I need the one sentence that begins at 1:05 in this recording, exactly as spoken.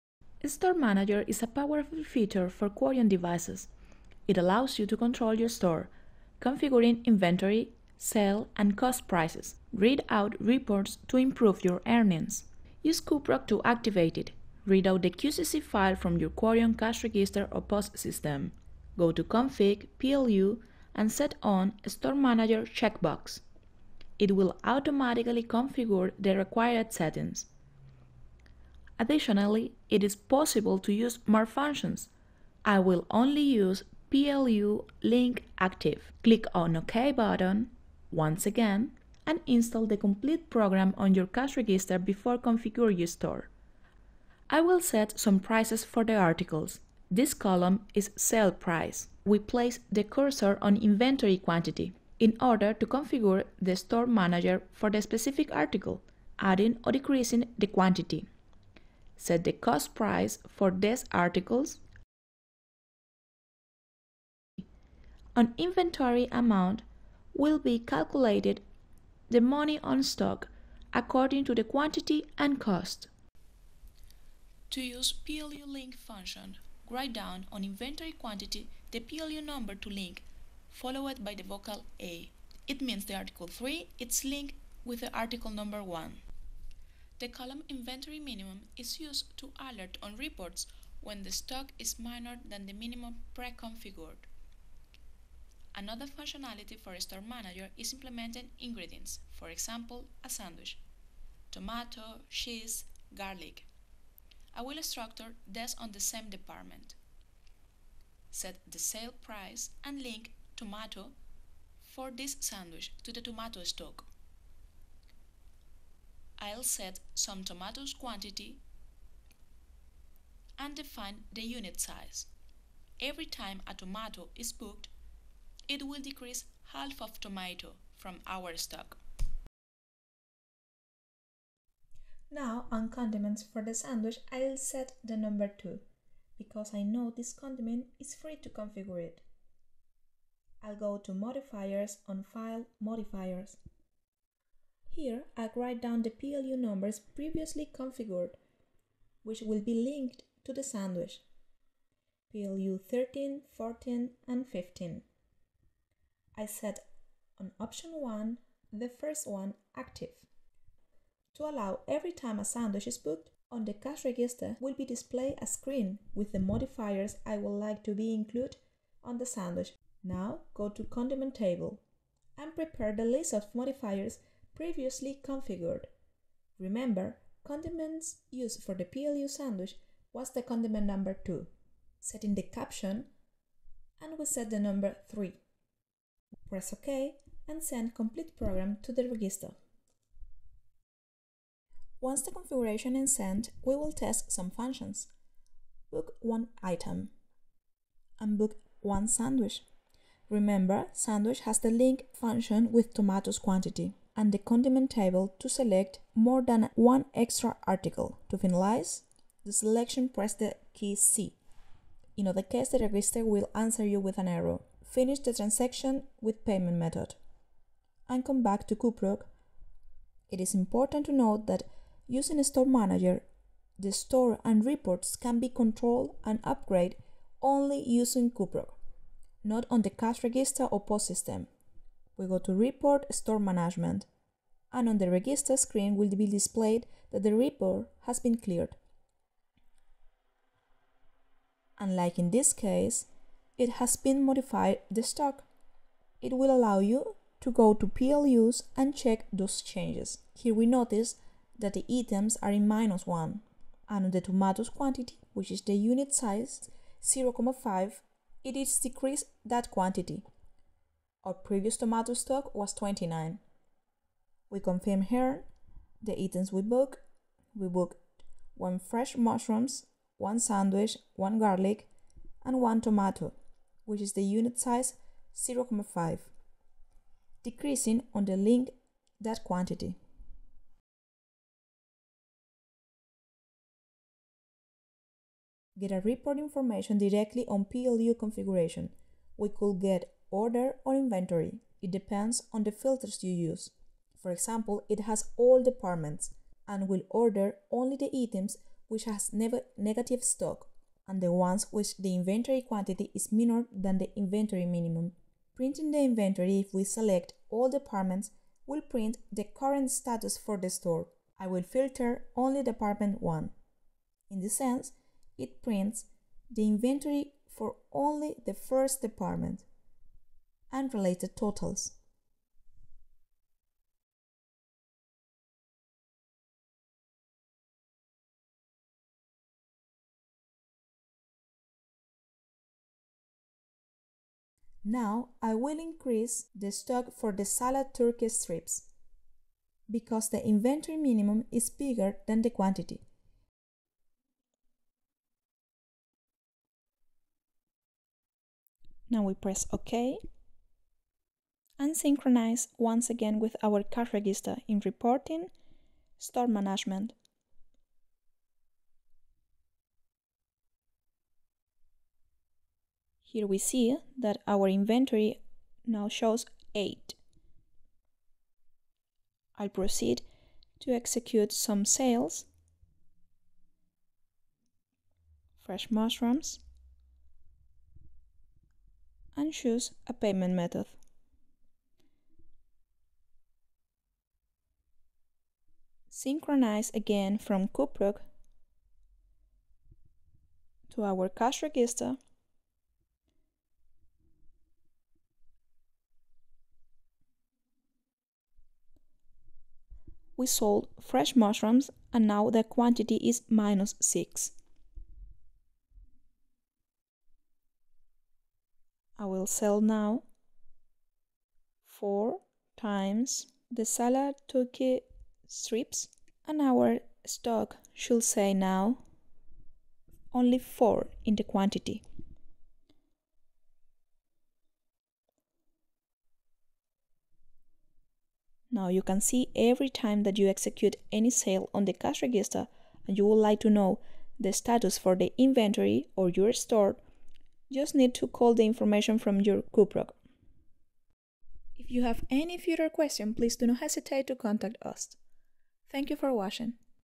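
An inventory amount will be calculated the money on stock according to the quantity and cost.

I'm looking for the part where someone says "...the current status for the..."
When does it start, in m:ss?
5:09.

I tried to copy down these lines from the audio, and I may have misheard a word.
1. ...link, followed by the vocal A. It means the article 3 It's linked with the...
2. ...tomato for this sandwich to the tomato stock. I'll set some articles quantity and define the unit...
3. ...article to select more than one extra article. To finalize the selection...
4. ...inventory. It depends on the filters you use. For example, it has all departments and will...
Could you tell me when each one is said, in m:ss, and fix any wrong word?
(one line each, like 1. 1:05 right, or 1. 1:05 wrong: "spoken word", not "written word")
1. 1:19 right
2. 1:50 wrong: "tomatoes", not "articles"
3. 3:24 wrong: "table", not "article"
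4. 4:50 right.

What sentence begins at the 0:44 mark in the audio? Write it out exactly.
I will set some prices for the articles.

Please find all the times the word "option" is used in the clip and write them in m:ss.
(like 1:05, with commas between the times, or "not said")
2:37.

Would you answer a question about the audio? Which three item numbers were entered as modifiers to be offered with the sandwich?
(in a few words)
13, 14, and 15.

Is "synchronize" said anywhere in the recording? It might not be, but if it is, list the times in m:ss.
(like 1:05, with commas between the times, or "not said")
5:51, 6:26.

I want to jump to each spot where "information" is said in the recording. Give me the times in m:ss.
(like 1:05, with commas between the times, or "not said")
4:46, 7:18.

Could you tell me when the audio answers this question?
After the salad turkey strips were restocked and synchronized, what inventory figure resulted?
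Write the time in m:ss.
6:05.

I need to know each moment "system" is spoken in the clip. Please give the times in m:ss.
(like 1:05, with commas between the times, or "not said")
0:17, 3:51.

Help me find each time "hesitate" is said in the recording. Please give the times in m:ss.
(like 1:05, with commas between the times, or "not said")
7:23.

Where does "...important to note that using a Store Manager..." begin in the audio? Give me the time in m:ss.
3:40.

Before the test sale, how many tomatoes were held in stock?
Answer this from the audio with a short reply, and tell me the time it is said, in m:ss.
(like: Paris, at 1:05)
29, at 4:21.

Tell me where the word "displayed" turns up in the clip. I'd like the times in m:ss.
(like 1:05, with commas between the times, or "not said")
2:44, 3:56.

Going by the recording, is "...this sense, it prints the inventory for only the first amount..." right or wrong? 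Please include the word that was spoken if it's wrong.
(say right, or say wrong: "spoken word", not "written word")
wrong: "department", not "amount".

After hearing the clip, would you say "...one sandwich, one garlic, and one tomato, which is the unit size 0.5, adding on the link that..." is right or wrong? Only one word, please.
wrong.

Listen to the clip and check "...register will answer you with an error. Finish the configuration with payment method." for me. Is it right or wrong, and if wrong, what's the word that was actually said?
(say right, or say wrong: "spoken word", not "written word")
wrong: "transaction", not "configuration".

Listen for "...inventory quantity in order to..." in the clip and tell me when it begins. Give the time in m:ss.
0:50.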